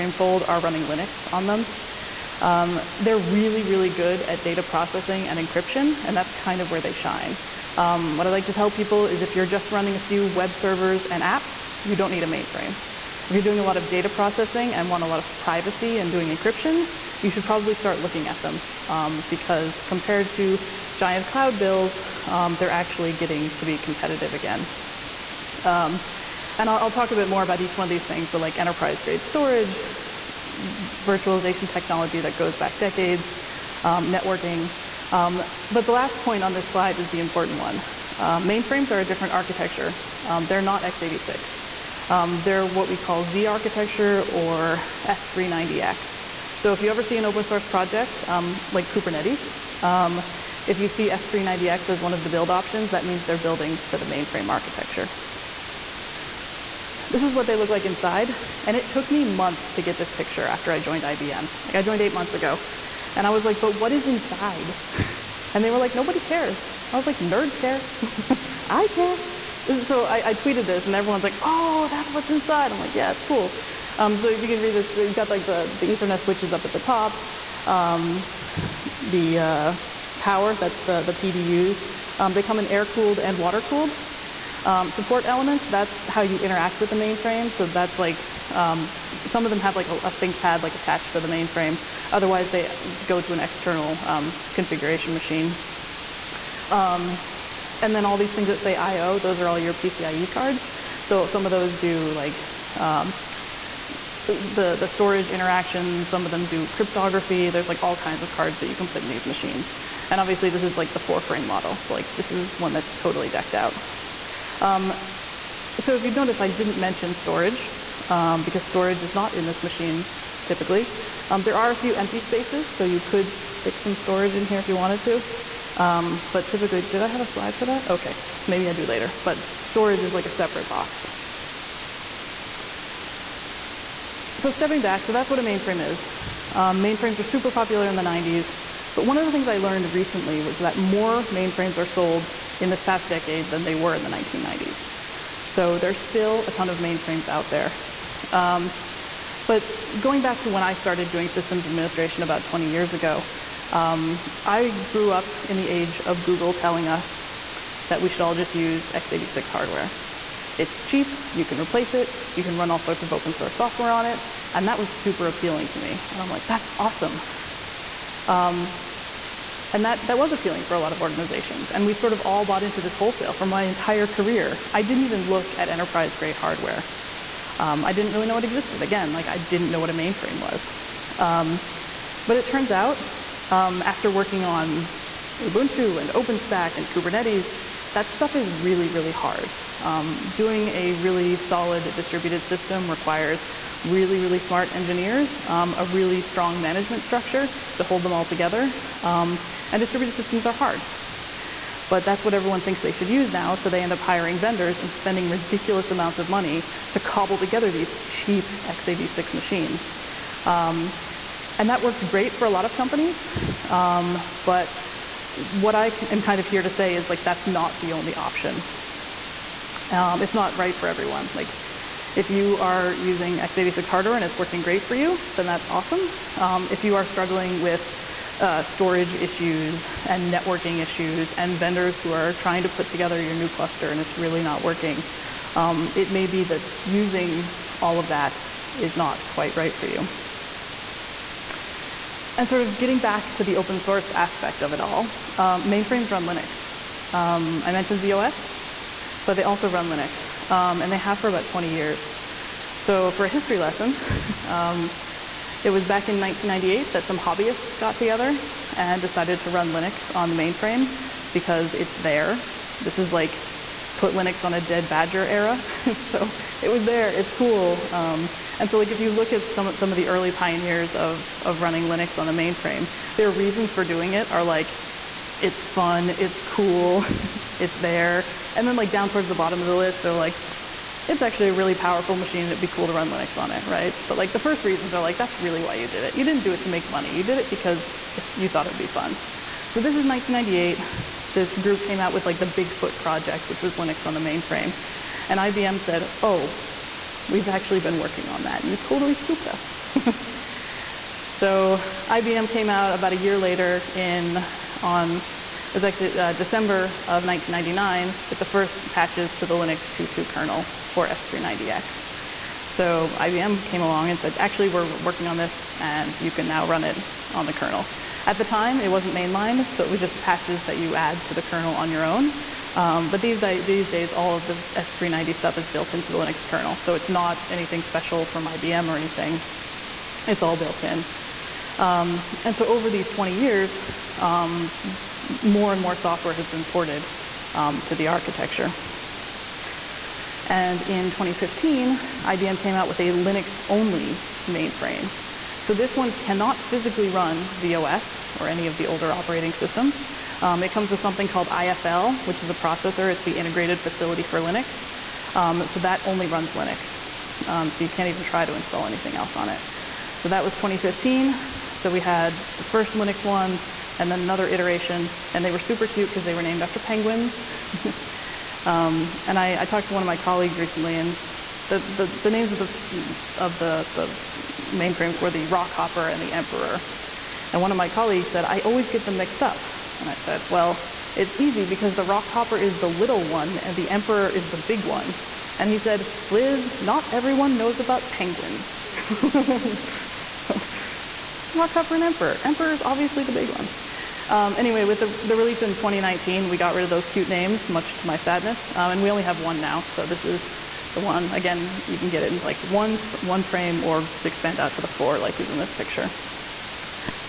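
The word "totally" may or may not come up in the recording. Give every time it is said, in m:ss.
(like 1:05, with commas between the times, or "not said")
1:52, 4:58.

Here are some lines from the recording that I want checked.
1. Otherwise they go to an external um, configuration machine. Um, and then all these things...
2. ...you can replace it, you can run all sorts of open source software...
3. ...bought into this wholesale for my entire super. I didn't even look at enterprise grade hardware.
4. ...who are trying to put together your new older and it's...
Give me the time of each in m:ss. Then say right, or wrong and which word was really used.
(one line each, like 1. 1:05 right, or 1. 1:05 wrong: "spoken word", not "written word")
1. 1:32 right
2. 2:41 right
3. 2:52 wrong: "career", not "super"
4. 3:52 wrong: "cluster", not "older".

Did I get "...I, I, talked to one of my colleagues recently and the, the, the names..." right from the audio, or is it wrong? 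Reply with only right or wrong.
right.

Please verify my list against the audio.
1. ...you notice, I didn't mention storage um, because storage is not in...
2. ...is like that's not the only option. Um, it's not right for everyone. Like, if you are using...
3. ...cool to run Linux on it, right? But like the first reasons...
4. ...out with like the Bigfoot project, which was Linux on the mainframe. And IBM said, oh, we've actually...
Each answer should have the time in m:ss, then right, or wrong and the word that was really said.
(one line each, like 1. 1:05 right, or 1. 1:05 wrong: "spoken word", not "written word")
1. 1:56 right
2. 3:36 right
3. 4:42 right
4. 4:51 right.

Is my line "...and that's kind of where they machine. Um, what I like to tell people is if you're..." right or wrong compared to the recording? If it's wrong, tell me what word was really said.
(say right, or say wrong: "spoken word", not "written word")
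wrong: "shine", not "machine".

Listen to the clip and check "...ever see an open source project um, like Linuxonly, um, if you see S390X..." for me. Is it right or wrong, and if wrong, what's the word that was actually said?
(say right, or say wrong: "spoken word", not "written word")
wrong: "Kubernetes", not "Linuxonly".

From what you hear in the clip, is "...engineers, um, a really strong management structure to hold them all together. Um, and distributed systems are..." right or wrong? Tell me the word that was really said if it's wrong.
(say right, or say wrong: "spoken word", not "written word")
right.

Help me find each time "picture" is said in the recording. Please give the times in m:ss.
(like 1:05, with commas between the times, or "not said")
1:00, 6:45.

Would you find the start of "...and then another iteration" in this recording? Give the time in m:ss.
6:03.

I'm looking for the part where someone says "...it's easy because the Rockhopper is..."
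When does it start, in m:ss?
6:21.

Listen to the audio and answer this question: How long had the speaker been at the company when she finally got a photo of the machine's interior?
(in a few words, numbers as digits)
eight months.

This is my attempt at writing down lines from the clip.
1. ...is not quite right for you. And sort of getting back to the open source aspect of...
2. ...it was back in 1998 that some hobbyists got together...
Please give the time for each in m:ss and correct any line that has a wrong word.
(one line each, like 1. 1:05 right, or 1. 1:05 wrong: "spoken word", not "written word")
1. 3:58 right
2. 4:15 right.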